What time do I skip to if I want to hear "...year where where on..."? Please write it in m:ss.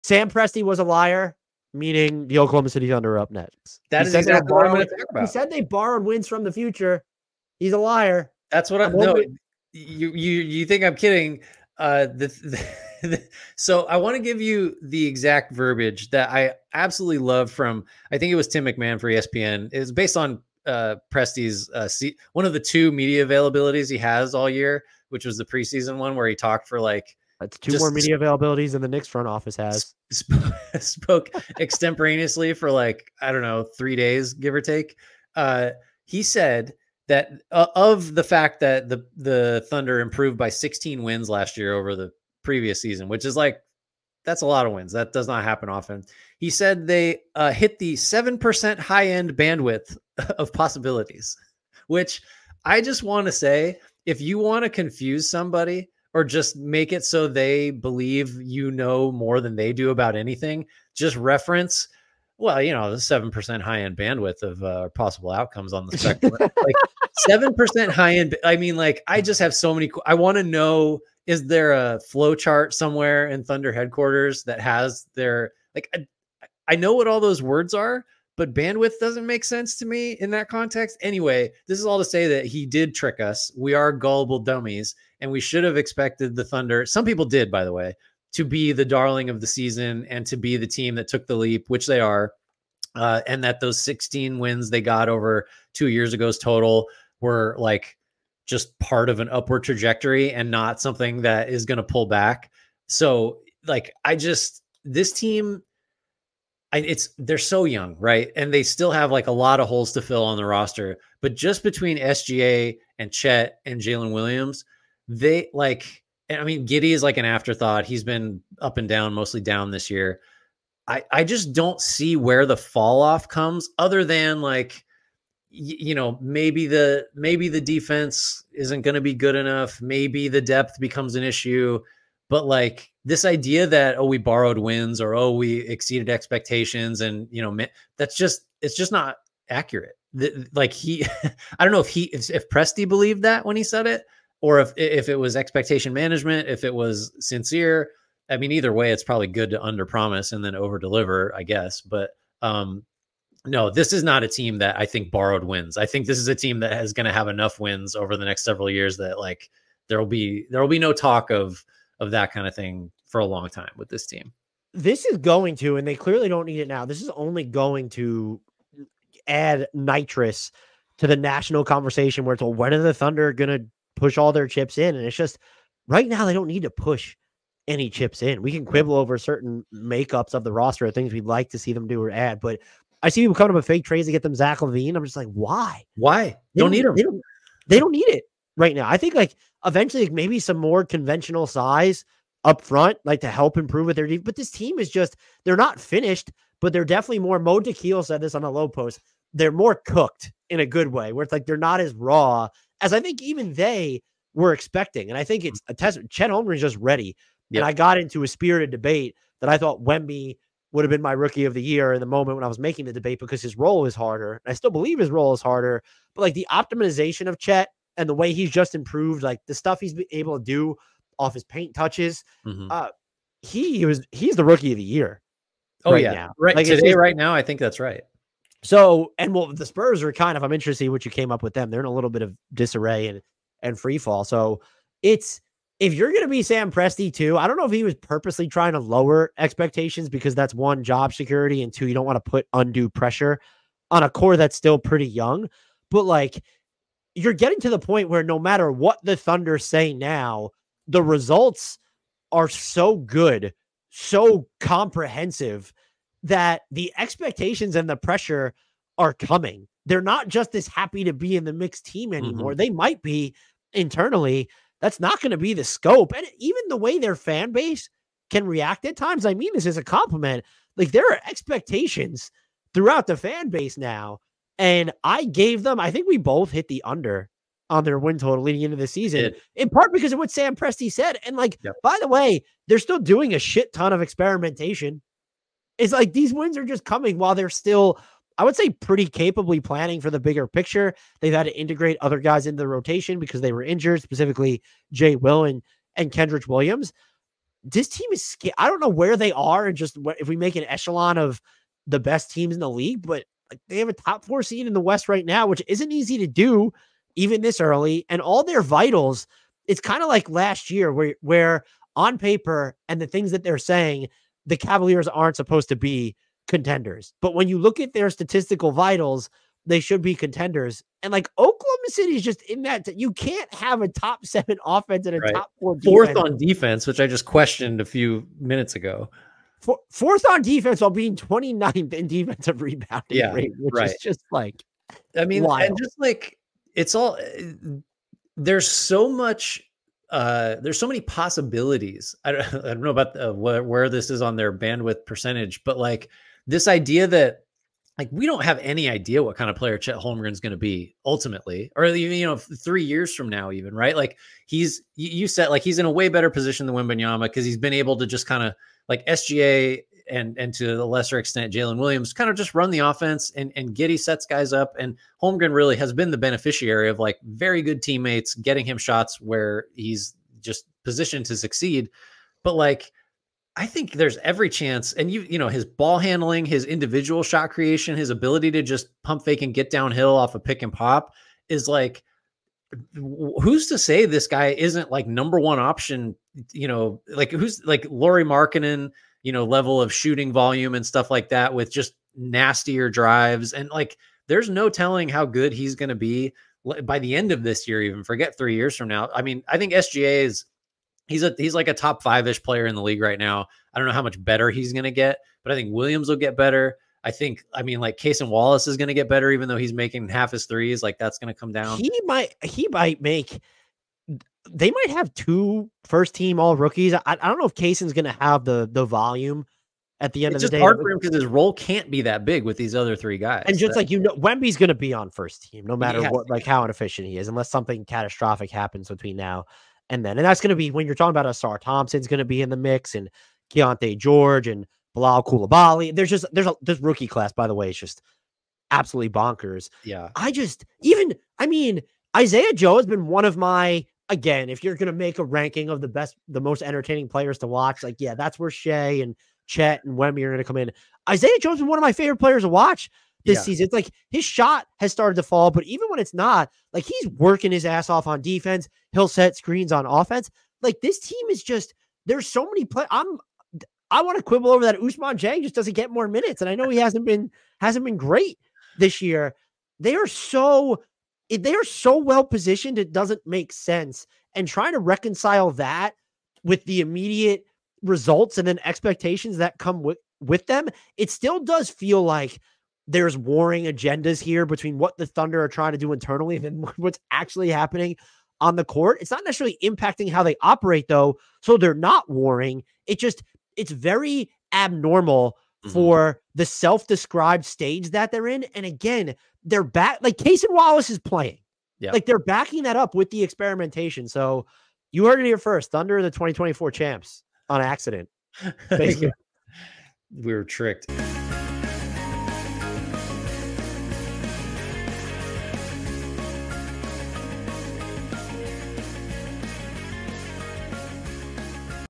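5:10.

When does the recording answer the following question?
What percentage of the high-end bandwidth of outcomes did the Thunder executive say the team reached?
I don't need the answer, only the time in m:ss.
0:47.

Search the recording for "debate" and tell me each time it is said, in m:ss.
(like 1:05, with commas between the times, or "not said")
3:28, 3:32.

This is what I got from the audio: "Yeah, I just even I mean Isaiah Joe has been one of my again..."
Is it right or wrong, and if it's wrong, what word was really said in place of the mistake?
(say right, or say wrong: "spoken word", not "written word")
right.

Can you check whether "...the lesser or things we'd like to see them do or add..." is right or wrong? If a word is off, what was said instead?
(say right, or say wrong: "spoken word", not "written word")
wrong: "roster", not "lesser".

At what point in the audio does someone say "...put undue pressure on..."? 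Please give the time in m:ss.
4:02.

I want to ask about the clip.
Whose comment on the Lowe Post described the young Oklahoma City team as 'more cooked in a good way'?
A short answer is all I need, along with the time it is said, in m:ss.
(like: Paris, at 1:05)
Mo Dakhil, at 3:17.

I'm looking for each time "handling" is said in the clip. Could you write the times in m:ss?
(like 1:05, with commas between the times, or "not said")
6:15.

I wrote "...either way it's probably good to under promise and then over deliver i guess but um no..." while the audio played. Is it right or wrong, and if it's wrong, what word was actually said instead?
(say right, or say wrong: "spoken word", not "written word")
right.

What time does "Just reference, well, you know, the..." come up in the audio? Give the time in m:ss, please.
1:00.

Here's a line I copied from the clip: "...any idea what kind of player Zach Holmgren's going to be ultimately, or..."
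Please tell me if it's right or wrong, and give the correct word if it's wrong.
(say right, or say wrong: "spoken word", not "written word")
wrong: "Chet", not "Zach".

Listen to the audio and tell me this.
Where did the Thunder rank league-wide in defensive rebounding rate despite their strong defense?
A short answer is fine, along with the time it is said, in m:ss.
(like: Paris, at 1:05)
29th, at 5:31.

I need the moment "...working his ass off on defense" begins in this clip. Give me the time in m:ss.
7:37.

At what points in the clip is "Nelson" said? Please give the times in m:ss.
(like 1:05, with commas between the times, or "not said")
not said.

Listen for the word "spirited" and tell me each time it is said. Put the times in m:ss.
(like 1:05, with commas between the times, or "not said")
3:28.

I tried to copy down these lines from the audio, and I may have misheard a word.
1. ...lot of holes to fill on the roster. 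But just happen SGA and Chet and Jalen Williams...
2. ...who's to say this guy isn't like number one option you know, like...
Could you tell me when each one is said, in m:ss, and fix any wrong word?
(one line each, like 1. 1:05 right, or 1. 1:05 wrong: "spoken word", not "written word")
1. 1:49 wrong: "between", not "happen"
2. 6:23 right.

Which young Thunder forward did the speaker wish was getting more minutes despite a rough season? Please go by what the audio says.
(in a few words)
Ousmane Dieng.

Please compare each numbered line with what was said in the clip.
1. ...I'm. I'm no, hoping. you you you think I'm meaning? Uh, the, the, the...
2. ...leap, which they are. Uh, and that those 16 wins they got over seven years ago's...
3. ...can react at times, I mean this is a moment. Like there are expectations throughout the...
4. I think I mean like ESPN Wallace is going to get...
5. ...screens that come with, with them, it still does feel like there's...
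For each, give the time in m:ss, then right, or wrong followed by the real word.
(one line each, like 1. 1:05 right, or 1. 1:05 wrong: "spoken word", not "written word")
1. 0:08 wrong: "kidding", not "meaning"
2. 1:31 wrong: "two", not "seven"
3. 4:28 wrong: "compliment", not "moment"
4. 6:47 wrong: "Cason", not "ESPN"
5. 7:58 wrong: "expectations", not "screens".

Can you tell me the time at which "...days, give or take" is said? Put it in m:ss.
0:33.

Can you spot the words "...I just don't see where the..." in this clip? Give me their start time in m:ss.
2:01.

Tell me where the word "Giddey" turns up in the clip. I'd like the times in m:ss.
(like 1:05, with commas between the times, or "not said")
1:56, 6:03.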